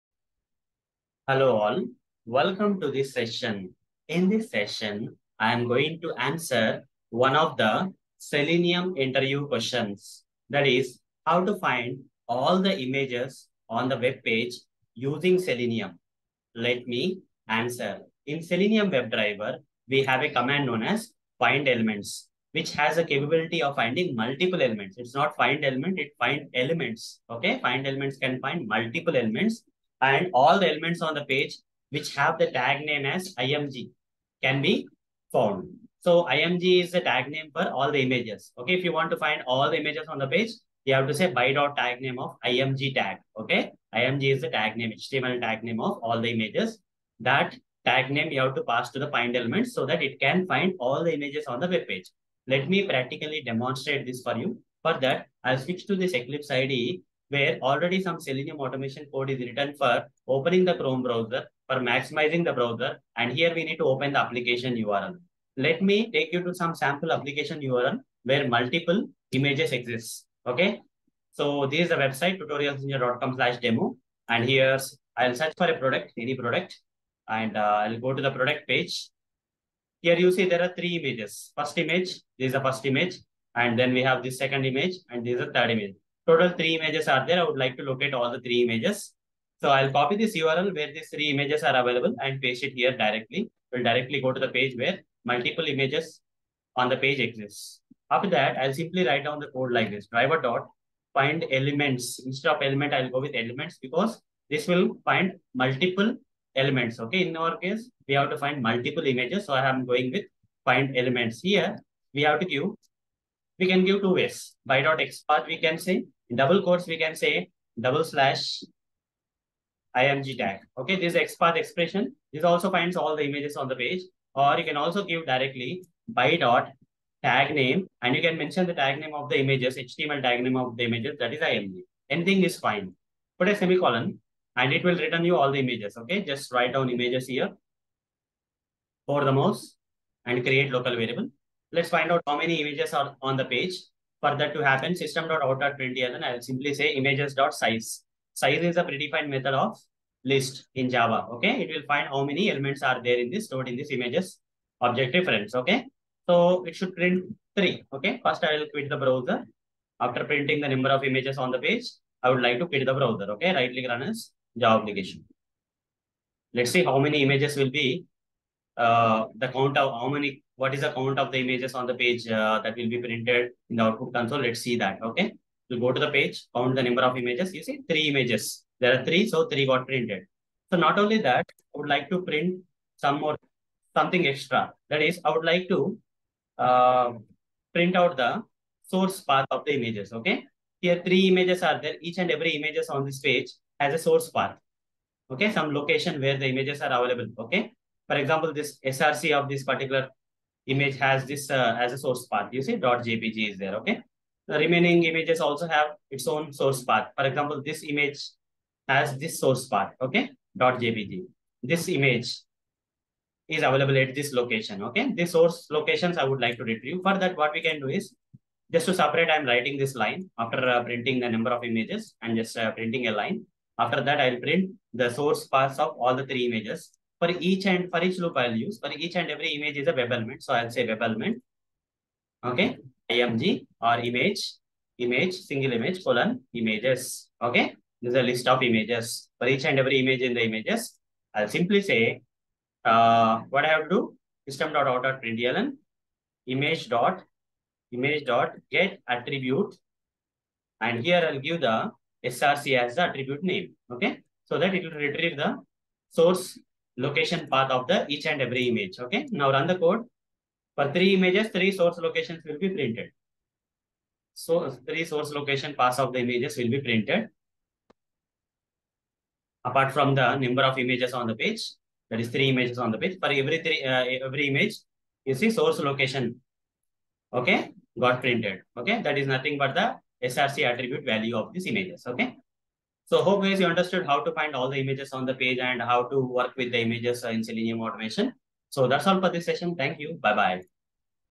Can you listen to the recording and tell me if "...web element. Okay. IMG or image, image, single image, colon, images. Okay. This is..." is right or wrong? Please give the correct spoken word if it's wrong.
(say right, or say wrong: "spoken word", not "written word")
right.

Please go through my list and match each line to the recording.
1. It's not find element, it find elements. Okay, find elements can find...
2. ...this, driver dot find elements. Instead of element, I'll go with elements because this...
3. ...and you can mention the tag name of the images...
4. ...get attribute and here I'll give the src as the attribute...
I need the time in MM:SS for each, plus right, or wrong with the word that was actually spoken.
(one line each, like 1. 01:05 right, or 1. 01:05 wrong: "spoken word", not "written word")
1. 00:24 right
2. 01:39 right
3. 02:08 right
4. 04:08 right.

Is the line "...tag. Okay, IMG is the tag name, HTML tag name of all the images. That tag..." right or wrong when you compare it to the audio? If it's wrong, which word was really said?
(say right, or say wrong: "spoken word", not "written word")
right.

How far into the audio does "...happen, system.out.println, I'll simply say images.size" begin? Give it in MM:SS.
02:24.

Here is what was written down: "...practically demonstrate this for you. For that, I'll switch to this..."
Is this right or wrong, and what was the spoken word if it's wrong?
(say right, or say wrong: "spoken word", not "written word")
right.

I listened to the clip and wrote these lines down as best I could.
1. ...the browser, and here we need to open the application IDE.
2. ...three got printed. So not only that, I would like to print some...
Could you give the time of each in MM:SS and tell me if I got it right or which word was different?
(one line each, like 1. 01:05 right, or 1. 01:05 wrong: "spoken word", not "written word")
1. 01:02 wrong: "URL", not "IDE"
2. 02:59 right.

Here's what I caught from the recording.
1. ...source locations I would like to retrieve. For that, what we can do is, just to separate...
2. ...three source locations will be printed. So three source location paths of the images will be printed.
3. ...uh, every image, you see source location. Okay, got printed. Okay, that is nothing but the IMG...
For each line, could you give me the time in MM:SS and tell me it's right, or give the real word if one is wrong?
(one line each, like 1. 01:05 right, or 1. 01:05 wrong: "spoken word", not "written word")
1. 03:35 right
2. 04:21 right
3. 04:33 wrong: "SRC", not "IMG".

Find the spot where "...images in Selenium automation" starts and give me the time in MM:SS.
04:46.